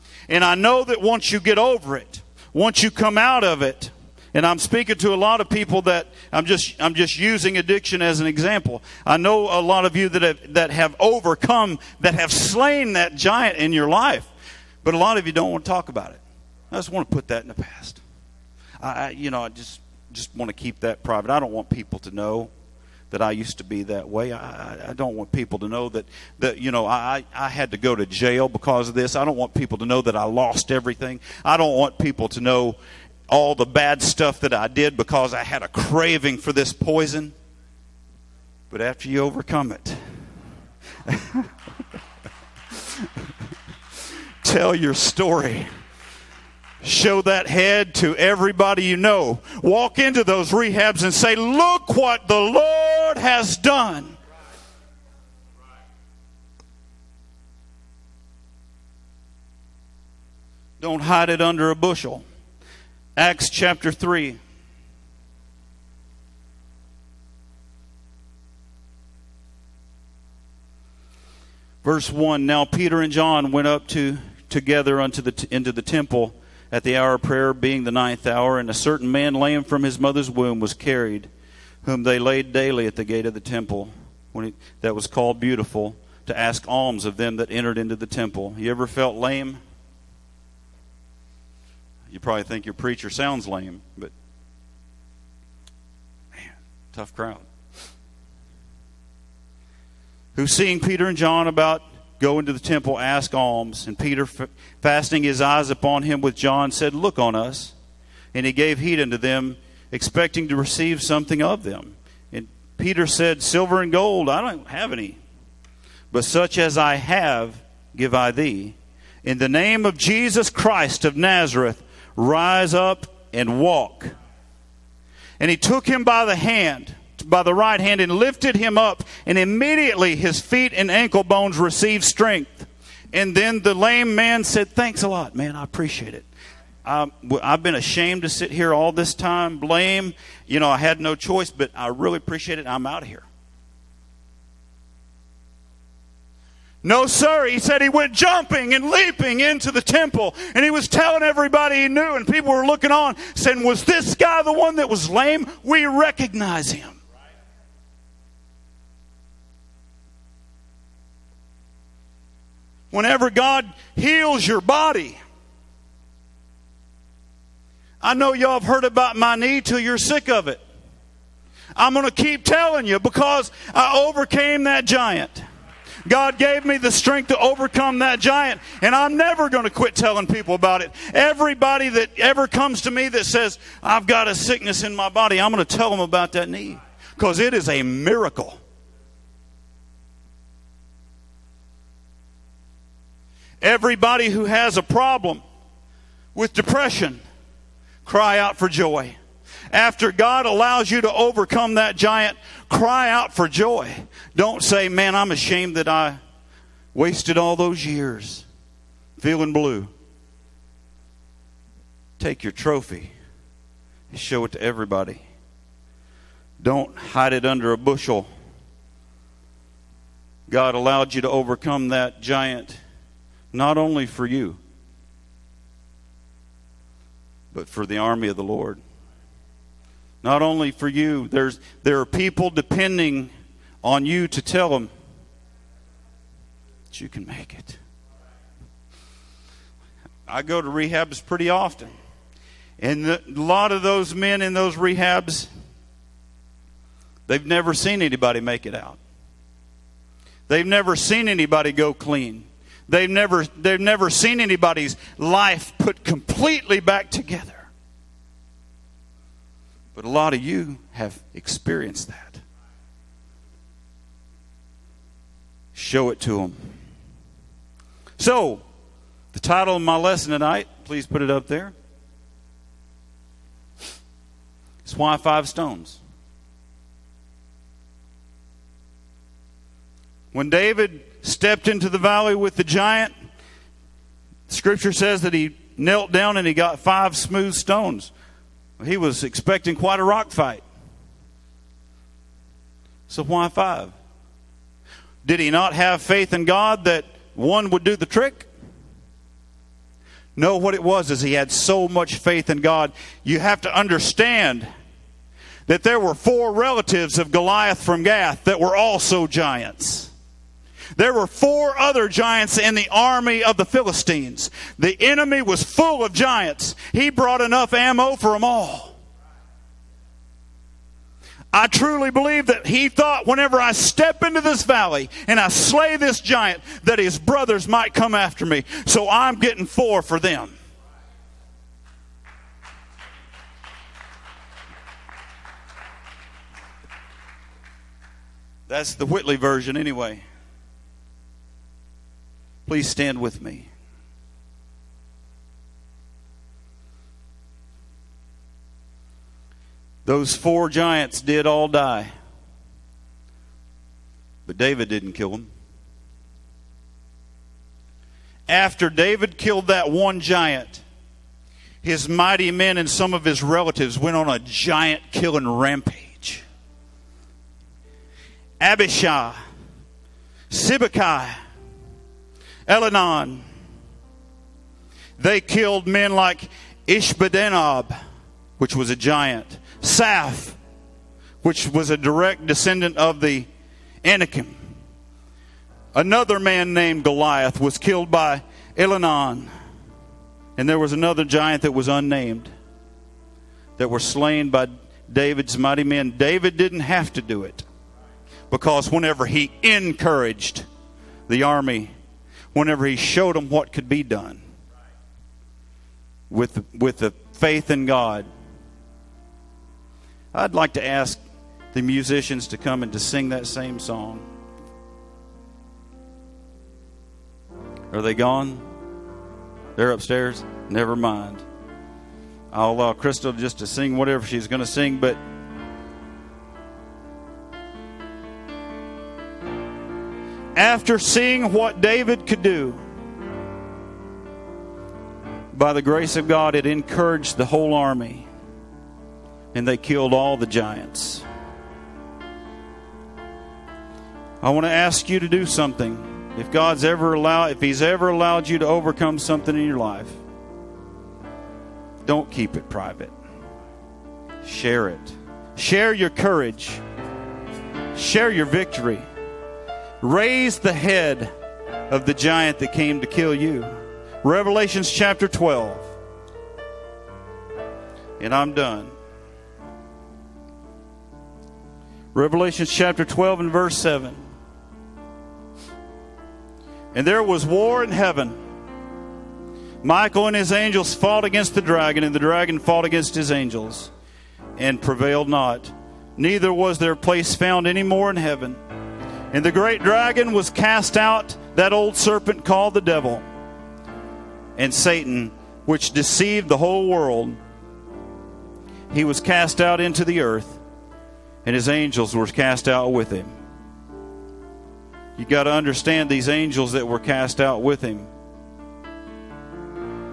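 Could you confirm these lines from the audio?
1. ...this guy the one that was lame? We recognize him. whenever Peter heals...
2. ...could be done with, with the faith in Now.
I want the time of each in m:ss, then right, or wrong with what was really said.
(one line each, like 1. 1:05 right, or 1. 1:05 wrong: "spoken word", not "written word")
1. 2:33 wrong: "God", not "Peter"
2. 6:43 wrong: "God", not "Now".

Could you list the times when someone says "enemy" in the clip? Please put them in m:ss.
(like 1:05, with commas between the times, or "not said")
5:15.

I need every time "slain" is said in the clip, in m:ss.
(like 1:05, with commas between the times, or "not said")
0:12, 6:33.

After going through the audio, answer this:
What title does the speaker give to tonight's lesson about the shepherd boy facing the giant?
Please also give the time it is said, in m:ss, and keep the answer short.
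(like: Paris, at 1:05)
Why five stones, at 4:34.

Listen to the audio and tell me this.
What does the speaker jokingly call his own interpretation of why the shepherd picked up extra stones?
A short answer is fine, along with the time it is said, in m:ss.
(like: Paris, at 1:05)
The Whitley version, at 5:38.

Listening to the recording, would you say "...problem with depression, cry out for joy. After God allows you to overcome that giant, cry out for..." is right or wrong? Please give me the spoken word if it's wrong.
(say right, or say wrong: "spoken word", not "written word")
right.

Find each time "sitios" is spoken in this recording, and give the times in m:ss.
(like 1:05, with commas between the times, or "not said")
not said.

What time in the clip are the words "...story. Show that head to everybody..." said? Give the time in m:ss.
0:44.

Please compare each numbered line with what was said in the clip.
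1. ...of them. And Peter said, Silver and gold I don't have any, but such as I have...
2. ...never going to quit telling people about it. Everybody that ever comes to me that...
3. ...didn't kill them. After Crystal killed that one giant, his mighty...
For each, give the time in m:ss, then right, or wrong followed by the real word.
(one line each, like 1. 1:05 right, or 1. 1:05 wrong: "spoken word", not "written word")
1. 1:51 right
2. 2:59 right
3. 5:54 wrong: "David", not "Crystal".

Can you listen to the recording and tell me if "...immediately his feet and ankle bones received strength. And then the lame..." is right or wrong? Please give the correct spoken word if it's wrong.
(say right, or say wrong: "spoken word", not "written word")
right.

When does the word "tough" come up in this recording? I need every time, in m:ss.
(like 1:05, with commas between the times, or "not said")
1:36.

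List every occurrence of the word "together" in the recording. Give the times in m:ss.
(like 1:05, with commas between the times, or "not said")
1:14, 4:17.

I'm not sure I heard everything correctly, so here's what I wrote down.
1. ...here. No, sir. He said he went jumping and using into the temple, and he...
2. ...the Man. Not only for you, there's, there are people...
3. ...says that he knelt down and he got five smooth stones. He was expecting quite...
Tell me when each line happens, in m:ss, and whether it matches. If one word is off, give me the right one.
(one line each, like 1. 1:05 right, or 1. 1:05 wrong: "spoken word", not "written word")
1. 2:23 wrong: "leaping", not "using"
2. 3:48 wrong: "Lord", not "Man"
3. 4:44 right.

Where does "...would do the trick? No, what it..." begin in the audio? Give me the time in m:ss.
4:57.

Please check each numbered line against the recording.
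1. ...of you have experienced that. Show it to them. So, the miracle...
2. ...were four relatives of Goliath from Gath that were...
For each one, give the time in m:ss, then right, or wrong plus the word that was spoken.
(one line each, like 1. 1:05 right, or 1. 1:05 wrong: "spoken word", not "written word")
1. 4:20 wrong: "title", not "miracle"
2. 5:05 right.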